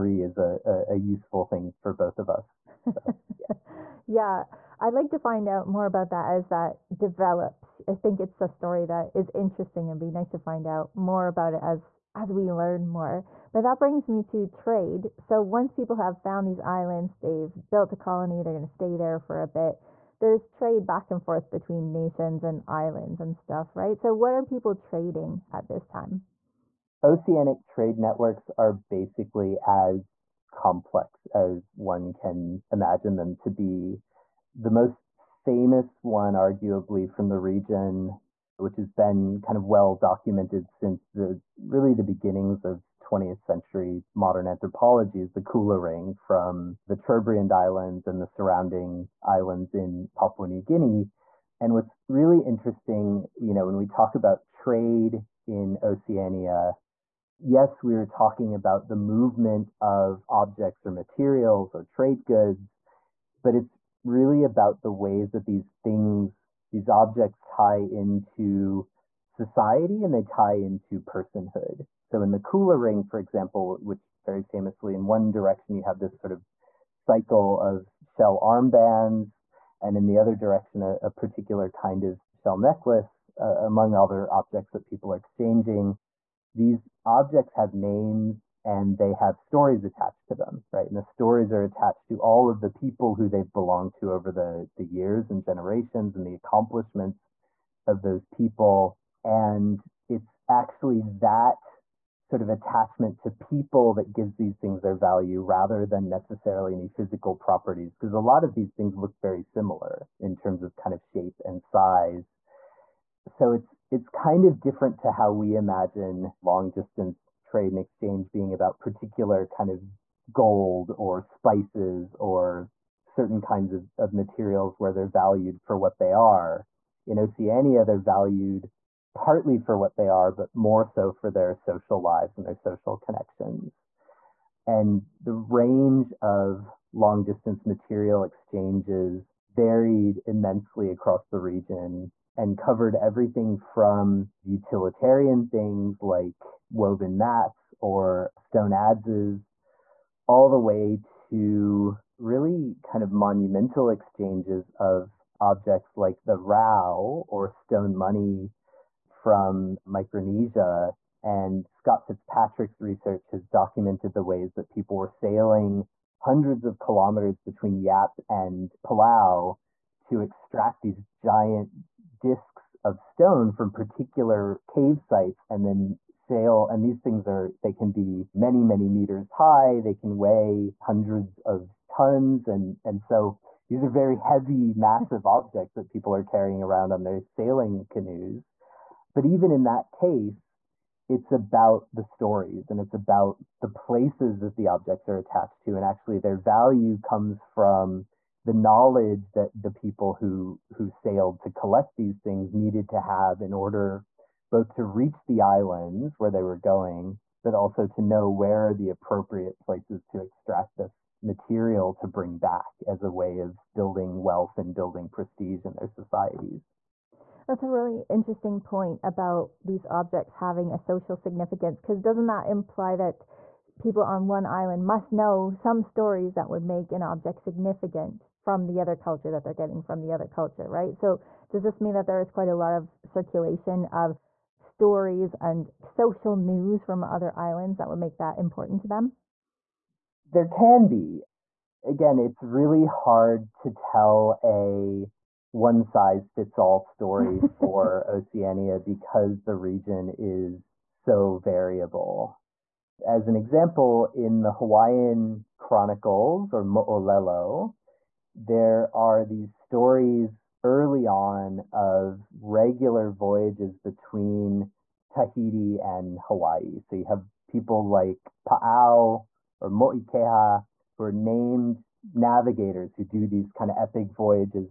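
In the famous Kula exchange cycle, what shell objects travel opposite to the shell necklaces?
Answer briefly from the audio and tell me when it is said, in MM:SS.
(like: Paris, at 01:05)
shell armbands, at 01:18.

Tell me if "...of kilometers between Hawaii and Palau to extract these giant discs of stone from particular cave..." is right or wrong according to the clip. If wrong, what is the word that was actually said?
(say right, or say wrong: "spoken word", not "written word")
wrong: "Yap", not "Hawaii".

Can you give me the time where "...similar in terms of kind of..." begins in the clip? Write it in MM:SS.
01:49.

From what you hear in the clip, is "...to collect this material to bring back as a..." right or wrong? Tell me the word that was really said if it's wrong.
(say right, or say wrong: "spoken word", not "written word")
wrong: "extract", not "collect".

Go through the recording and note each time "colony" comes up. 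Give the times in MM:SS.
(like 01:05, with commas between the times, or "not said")
00:17.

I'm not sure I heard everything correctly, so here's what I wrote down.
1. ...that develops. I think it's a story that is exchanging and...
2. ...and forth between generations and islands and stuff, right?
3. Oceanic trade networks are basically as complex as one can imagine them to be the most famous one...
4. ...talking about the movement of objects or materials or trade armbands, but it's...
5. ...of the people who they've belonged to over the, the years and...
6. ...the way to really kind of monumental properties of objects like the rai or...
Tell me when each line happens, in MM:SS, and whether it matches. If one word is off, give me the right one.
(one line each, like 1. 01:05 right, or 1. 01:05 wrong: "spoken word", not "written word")
1. 00:06 wrong: "interesting", not "exchanging"
2. 00:21 wrong: "nations", not "generations"
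3. 00:27 right
4. 00:58 wrong: "goods", not "armbands"
5. 01:32 right
6. 02:30 wrong: "exchanges", not "properties".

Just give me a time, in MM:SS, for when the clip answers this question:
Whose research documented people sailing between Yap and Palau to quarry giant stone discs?
02:41.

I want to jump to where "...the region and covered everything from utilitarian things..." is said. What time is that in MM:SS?
02:21.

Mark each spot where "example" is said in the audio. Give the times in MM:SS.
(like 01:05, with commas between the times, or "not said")
01:13, 04:13.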